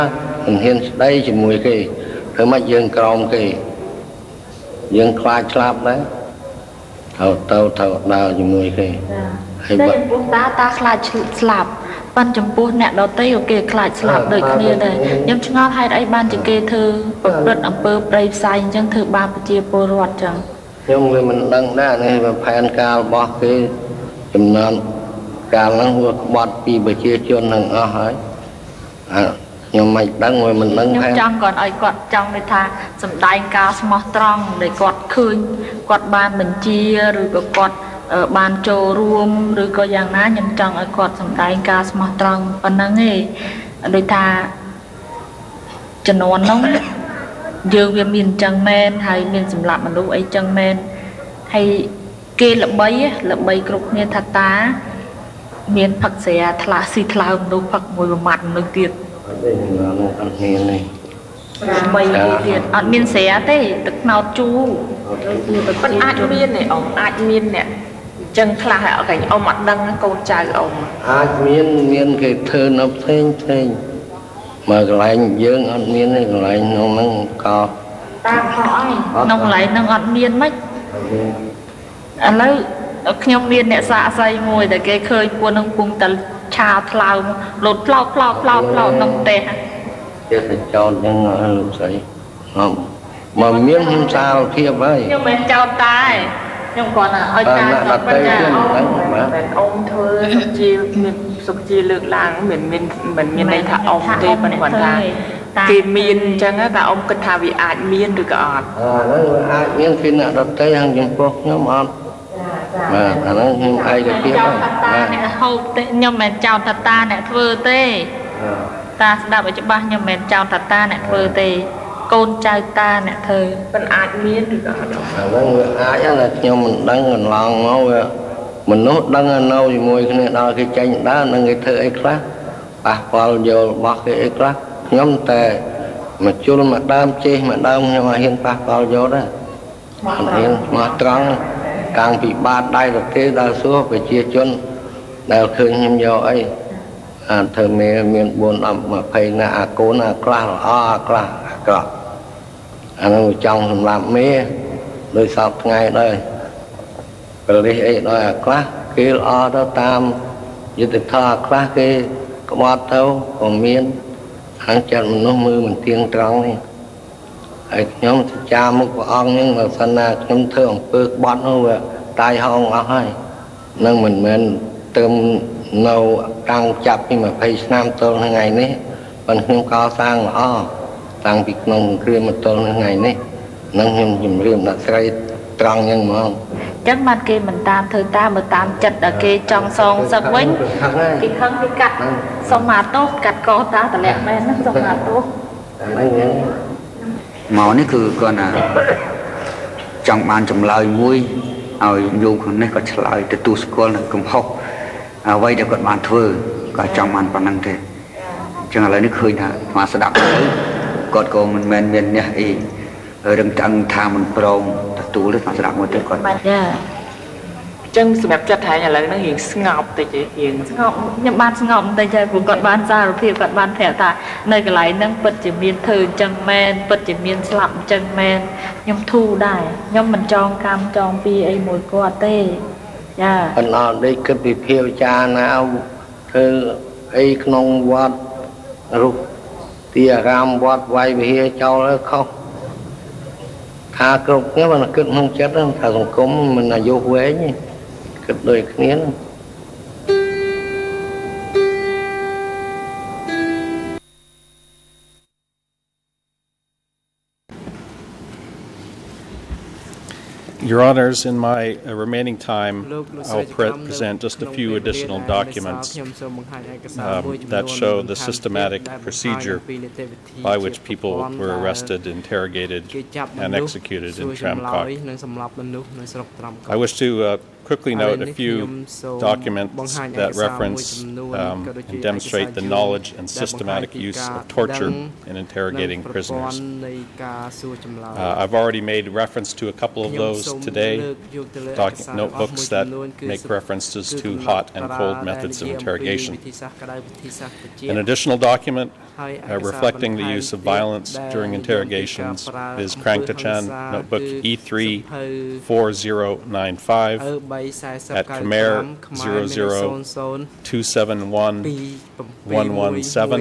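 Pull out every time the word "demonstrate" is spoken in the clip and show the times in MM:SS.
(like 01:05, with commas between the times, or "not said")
04:42.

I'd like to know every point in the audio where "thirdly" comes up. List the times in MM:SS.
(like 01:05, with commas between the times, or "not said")
not said.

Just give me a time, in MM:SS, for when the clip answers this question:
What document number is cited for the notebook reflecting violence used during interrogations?
05:04.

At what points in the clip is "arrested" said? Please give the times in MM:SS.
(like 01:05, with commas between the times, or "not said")
04:31.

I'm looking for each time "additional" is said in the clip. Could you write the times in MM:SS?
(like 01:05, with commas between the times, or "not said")
04:24, 04:57.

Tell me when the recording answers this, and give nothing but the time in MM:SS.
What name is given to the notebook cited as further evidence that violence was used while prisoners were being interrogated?
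05:03.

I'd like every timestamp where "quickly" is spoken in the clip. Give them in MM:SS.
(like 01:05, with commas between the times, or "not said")
04:37.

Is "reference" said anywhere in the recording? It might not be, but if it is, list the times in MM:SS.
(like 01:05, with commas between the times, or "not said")
04:40, 04:49, 04:53.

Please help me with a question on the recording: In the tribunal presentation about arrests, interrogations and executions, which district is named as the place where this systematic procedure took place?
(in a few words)
Tram Kok.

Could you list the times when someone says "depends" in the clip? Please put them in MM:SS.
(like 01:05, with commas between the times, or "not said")
not said.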